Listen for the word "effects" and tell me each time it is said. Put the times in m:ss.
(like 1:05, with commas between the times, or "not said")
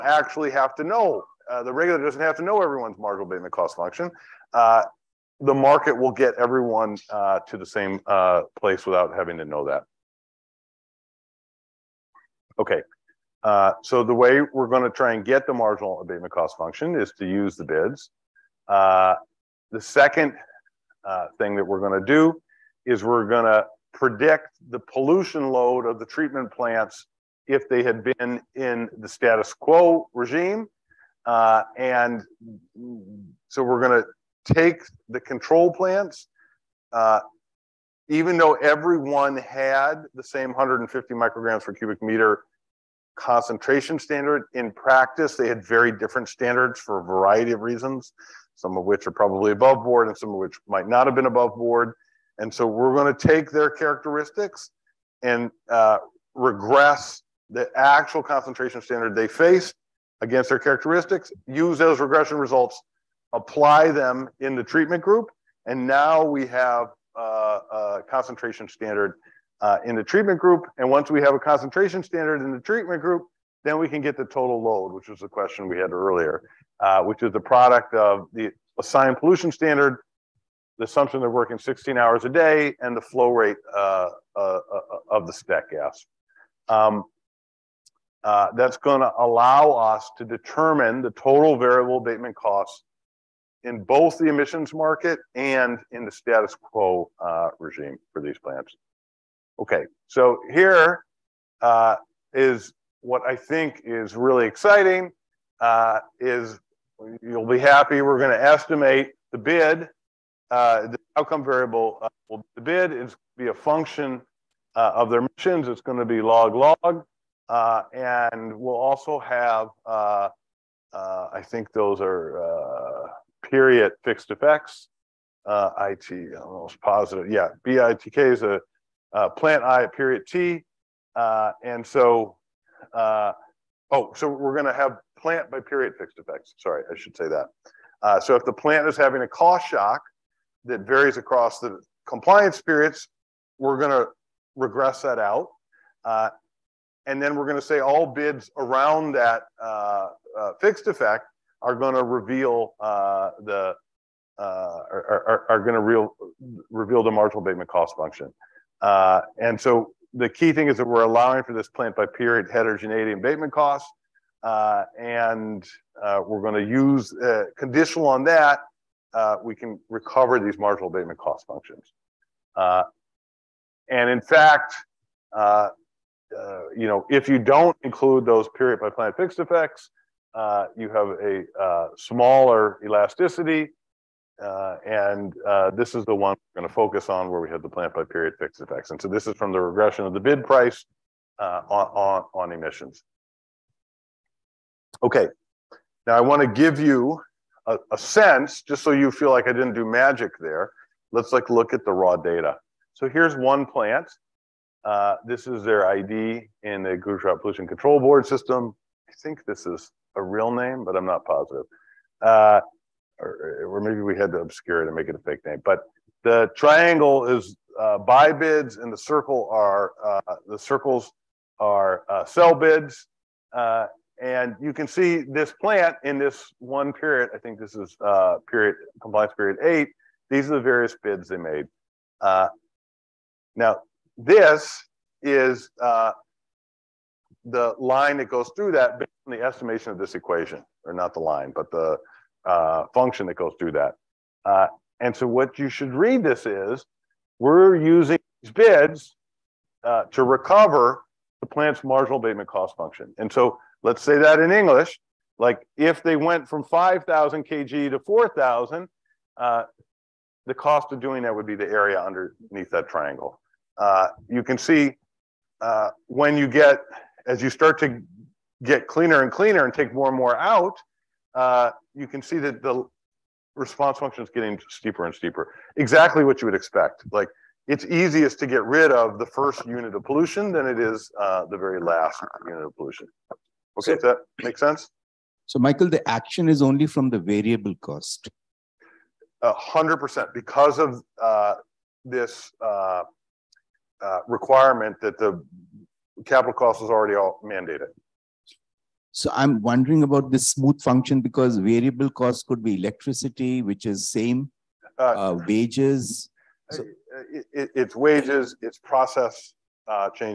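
2:04, 2:16, 2:30, 2:59, 3:08.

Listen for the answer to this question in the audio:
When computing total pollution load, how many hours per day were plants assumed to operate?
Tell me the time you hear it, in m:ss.
1:21.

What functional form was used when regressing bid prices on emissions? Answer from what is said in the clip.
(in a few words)
log log.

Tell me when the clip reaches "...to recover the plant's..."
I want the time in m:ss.
4:10.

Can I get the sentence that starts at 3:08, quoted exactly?
And so this is from the regression of the bid price uh, on, on, on emissions.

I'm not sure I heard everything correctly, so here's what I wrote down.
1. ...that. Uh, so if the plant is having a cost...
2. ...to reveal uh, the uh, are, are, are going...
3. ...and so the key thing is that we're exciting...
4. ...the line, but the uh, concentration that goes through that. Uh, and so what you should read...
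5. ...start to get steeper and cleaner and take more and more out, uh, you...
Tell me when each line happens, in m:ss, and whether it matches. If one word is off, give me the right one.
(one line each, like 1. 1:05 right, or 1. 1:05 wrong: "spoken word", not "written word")
1. 2:17 right
2. 2:31 right
3. 2:39 wrong: "allowing", not "exciting"
4. 4:01 wrong: "function", not "concentration"
5. 4:27 wrong: "cleaner", not "steeper".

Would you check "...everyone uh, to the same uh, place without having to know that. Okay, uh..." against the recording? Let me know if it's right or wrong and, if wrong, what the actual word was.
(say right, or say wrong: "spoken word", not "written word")
right.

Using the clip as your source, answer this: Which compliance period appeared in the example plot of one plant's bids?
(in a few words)
8.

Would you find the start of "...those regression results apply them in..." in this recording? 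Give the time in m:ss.
1:01.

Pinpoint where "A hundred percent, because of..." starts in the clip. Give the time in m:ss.
4:49.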